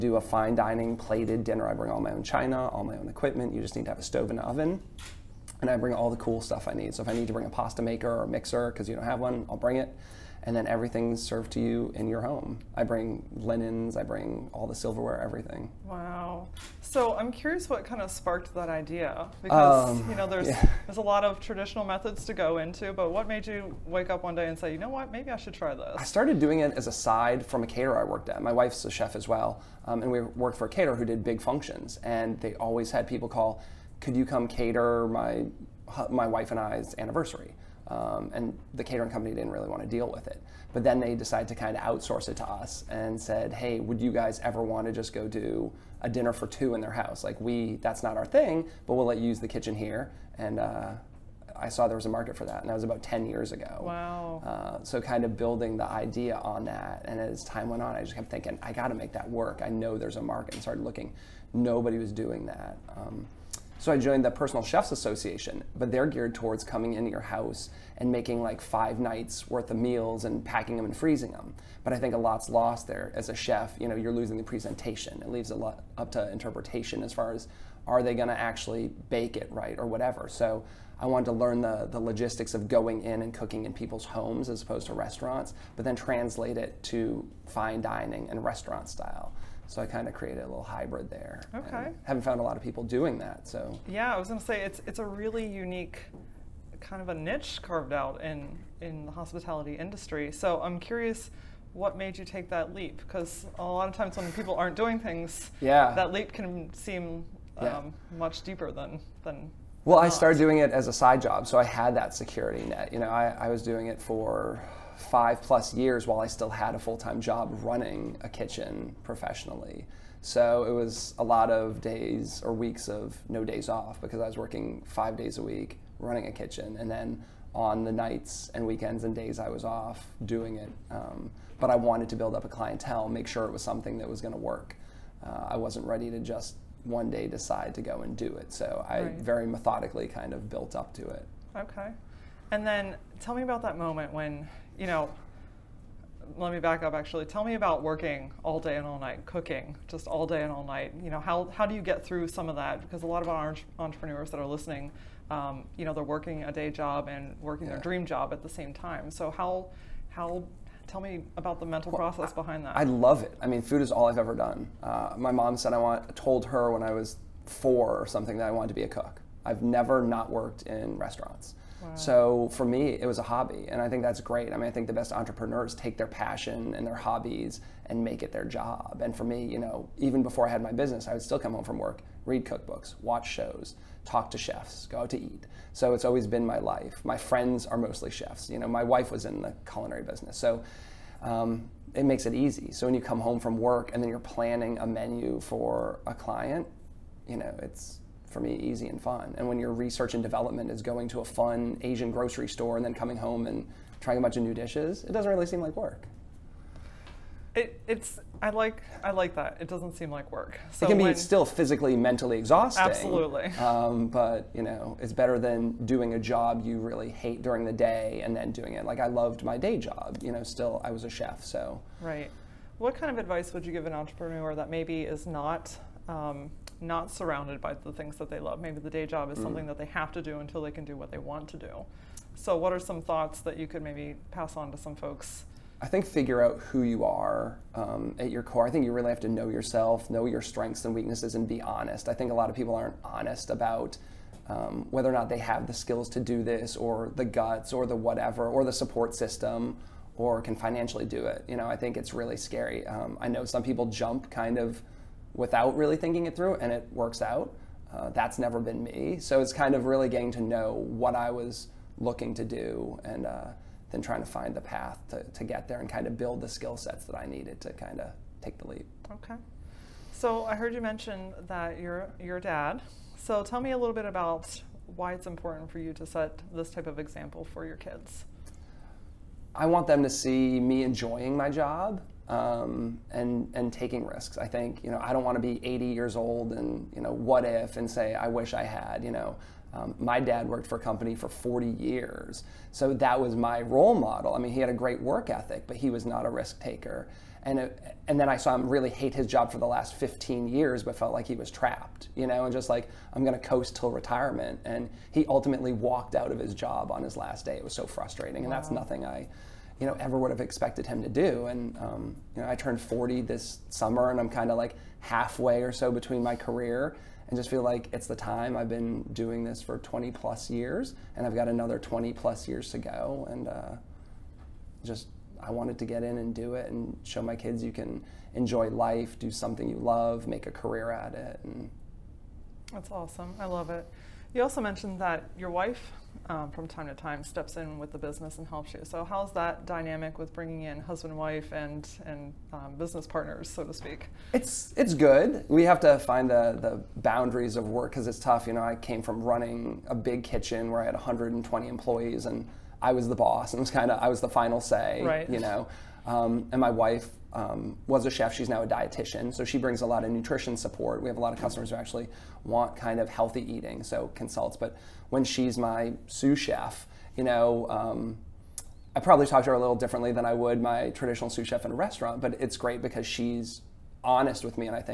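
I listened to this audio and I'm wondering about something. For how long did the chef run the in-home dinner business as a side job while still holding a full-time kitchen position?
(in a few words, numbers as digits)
five plus years.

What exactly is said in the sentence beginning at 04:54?
I mean, he had a great work ethic, but he was not a risk taker.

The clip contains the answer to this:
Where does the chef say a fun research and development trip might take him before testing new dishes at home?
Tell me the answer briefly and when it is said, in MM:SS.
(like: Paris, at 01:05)
Asian grocery store, at 03:21.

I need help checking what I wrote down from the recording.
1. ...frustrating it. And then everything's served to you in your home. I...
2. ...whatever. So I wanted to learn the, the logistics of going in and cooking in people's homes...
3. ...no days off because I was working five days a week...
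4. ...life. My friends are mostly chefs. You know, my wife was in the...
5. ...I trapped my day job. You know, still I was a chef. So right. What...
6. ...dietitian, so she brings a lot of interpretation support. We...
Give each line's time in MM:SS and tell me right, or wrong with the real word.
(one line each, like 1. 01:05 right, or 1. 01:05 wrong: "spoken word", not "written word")
1. 00:09 wrong: "bring", not "frustrating"
2. 01:19 right
3. 02:03 right
4. 03:06 right
5. 03:38 wrong: "loved", not "trapped"
6. 05:58 wrong: "nutrition", not "interpretation".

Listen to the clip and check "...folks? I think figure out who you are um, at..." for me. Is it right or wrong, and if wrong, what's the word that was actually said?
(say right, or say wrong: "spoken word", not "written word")
right.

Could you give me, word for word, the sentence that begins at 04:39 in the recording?
I want them to see me enjoying my job um, and and taking risks.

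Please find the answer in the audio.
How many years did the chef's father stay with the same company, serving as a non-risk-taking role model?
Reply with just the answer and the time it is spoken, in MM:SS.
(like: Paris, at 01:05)
40 years, at 04:51.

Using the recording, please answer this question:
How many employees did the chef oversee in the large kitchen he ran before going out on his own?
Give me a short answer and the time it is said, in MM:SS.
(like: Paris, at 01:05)
120, at 05:50.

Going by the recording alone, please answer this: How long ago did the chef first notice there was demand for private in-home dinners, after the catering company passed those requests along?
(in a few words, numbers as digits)
10 years ago.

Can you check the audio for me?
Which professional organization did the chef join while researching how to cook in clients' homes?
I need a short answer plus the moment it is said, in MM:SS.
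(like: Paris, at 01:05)
Personal Chefs Association, at 01:04.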